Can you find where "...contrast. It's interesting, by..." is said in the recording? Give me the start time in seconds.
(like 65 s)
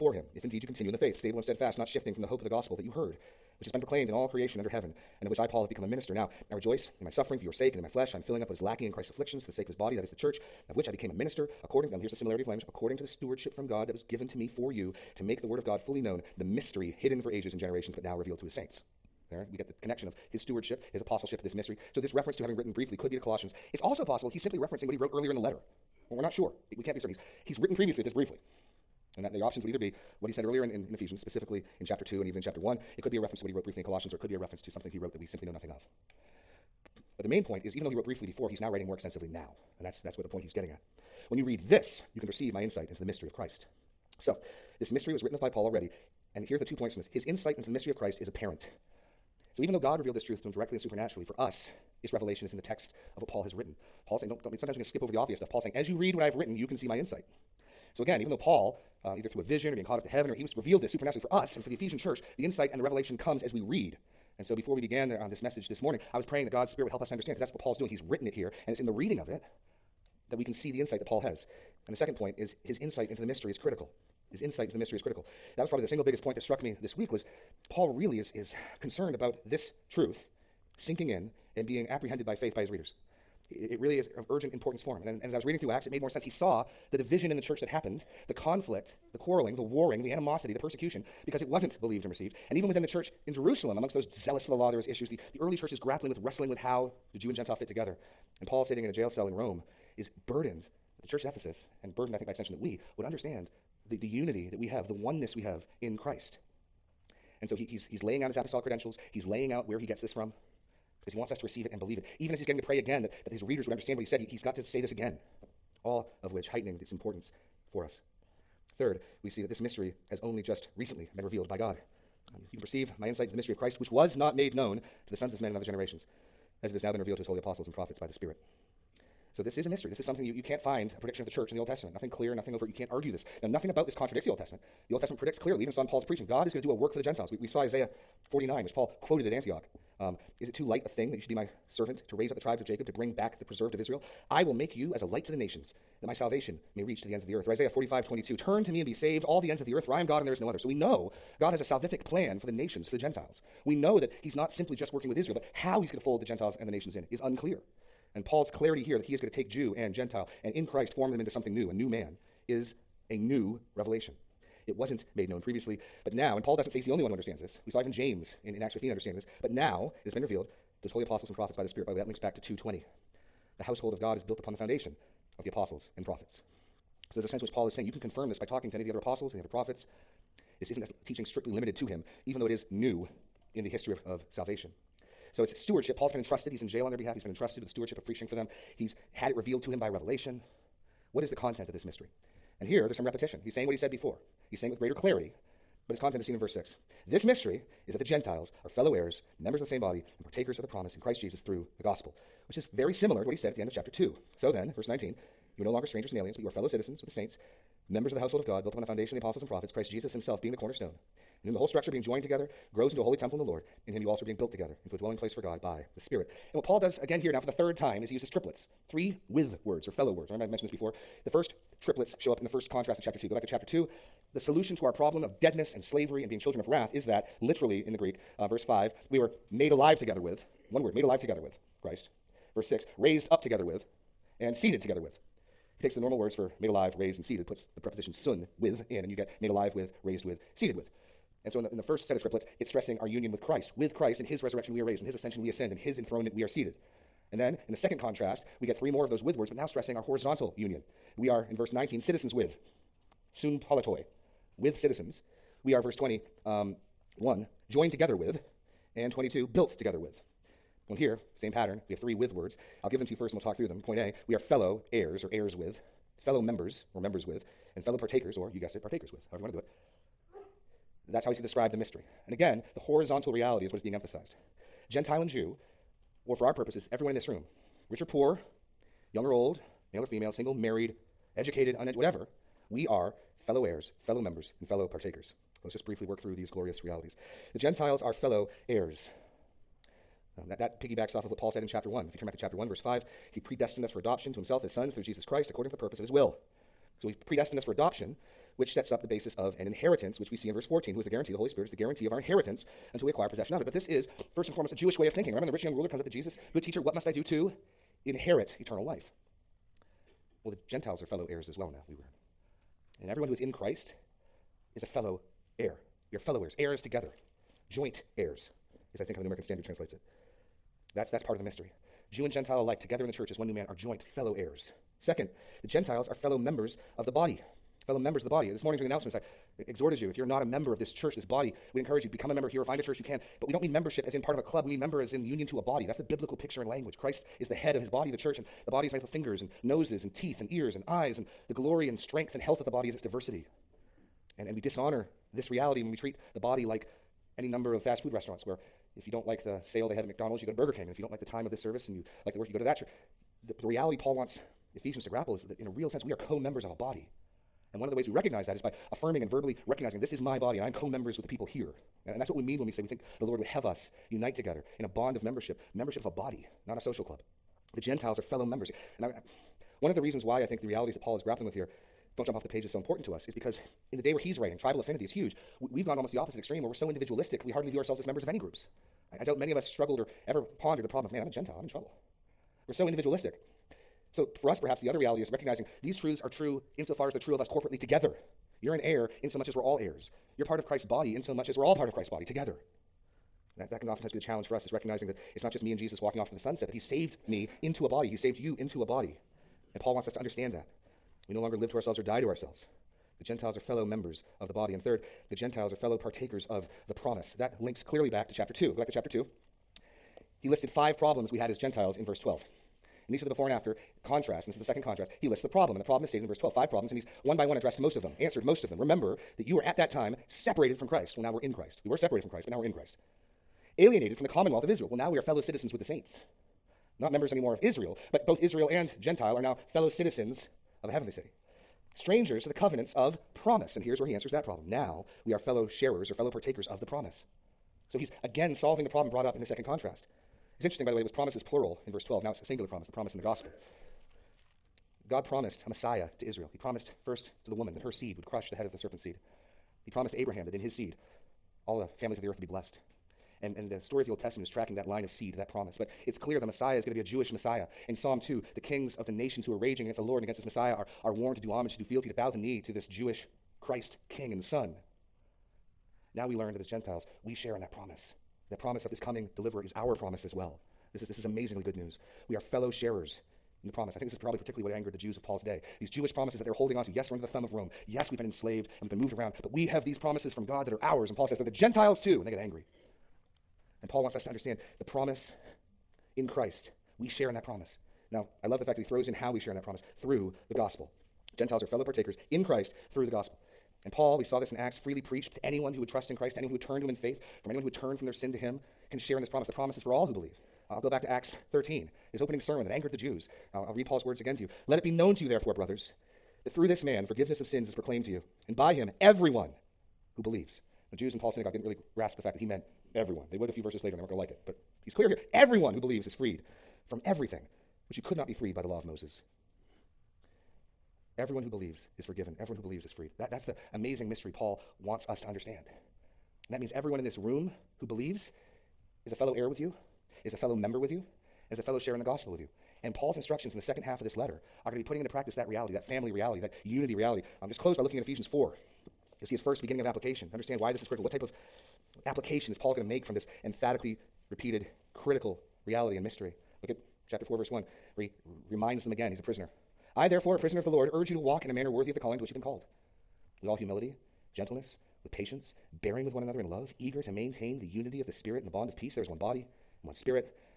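439 s.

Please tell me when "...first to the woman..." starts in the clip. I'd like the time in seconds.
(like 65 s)
447 s.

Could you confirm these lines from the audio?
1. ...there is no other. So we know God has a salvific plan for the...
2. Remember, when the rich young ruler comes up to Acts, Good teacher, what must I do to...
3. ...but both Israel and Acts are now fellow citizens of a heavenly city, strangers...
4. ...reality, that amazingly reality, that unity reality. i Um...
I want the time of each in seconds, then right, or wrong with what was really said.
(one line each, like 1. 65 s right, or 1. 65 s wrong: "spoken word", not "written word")
1. 150 s right
2. 305 s wrong: "Jesus", not "Acts"
3. 428 s wrong: "Gentile", not "Acts"
4. 535 s wrong: "family", not "amazingly".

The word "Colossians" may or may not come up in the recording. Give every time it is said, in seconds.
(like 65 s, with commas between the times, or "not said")
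23 s, 33 s.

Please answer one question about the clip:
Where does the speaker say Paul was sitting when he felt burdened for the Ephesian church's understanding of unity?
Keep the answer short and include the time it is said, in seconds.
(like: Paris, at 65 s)
A jail cell in Rome, at 98 s.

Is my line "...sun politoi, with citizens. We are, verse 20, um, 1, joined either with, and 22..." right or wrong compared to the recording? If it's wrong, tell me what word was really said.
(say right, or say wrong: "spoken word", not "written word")
wrong: "together", not "either".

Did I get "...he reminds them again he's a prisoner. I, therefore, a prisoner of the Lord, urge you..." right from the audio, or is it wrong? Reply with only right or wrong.
right.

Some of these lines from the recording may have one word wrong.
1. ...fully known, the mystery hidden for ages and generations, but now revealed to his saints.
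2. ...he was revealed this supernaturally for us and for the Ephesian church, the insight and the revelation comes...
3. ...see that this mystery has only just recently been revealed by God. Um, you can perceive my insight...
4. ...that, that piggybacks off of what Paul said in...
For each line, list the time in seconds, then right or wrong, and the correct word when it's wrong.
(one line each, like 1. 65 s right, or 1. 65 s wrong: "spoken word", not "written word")
1. 15 s right
2. 60 s right
3. 119 s right
4. 290 s right.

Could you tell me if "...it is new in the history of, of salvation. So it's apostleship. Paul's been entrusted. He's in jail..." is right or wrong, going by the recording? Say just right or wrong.
wrong.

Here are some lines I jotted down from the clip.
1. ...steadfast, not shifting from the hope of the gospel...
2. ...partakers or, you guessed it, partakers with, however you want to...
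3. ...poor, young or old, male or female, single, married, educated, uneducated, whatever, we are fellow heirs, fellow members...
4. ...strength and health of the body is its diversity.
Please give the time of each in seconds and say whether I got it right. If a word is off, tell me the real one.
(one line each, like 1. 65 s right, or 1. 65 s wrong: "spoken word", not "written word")
1. 1 s right
2. 267 s right
3. 278 s right
4. 341 s right.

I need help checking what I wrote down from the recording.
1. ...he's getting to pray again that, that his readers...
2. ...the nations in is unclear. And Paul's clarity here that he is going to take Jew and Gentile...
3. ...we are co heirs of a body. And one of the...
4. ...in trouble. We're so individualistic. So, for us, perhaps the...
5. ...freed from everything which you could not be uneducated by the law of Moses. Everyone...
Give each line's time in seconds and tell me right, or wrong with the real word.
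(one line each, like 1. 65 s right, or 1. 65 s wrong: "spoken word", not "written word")
1. 112 s right
2. 156 s right
3. 356 s wrong: "members", not "heirs"
4. 381 s right
5. 516 s wrong: "freed", not "uneducated".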